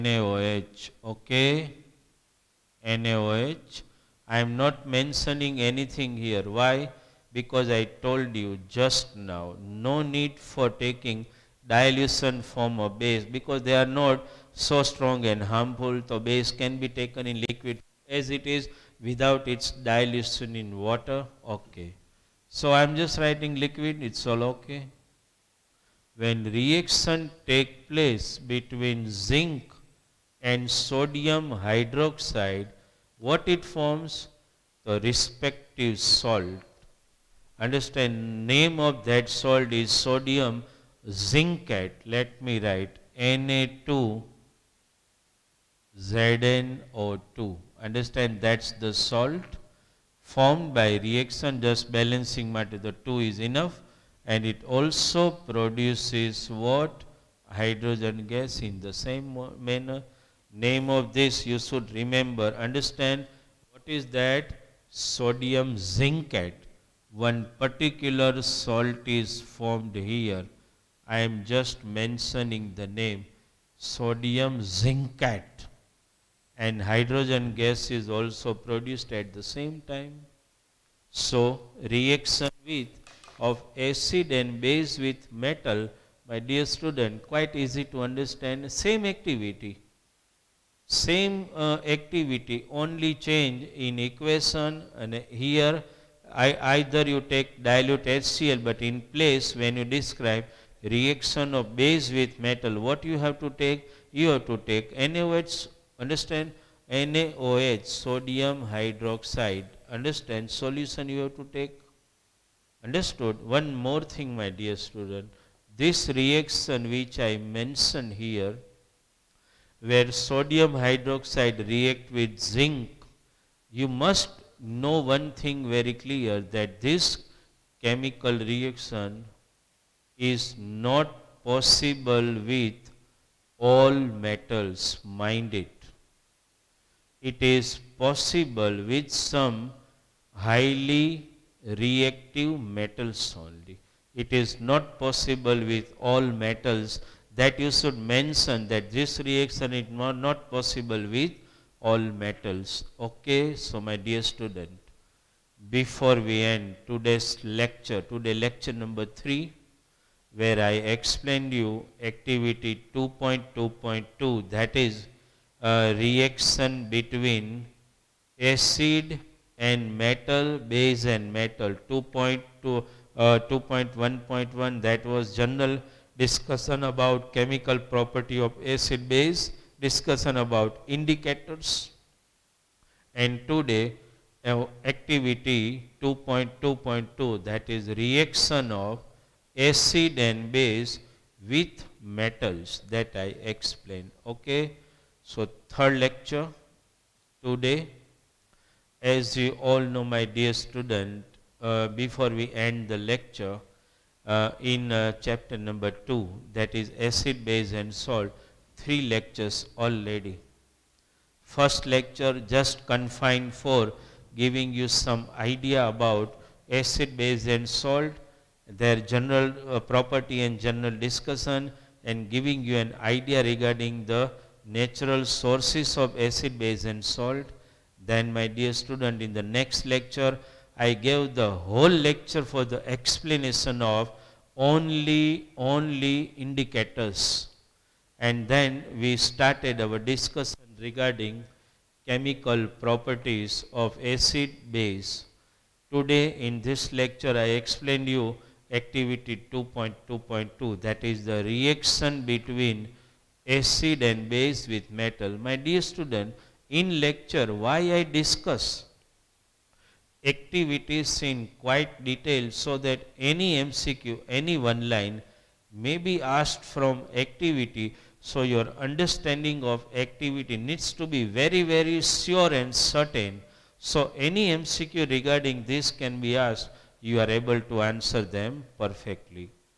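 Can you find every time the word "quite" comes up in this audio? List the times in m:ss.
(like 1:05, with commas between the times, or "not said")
1:27, 4:21.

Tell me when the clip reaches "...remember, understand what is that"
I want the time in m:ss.
1:01.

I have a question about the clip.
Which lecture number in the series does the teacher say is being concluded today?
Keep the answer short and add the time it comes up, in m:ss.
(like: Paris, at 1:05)
3, at 2:38.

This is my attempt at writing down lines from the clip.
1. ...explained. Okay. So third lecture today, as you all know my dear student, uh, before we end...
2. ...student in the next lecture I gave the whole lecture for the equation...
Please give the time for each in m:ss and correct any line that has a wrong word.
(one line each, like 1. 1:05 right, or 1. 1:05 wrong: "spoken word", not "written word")
1. 3:13 right
2. 3:48 wrong: "explanation", not "equation".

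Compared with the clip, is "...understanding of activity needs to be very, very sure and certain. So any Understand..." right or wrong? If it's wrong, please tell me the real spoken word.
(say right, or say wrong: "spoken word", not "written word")
wrong: "MCQ", not "Understand".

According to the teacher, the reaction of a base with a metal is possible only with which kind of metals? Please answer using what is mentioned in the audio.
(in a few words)
Highly reactive metals.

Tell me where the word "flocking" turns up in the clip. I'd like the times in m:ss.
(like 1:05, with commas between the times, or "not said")
not said.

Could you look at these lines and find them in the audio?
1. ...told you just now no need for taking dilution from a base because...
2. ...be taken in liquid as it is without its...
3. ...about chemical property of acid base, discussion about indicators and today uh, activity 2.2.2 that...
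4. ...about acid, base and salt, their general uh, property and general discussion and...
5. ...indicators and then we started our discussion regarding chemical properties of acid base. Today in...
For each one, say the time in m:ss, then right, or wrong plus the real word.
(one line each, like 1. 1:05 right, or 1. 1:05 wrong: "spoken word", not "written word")
1. 0:07 right
2. 0:16 right
3. 2:56 right
4. 3:35 right
5. 3:56 right.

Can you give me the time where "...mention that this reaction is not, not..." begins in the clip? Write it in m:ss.
2:27.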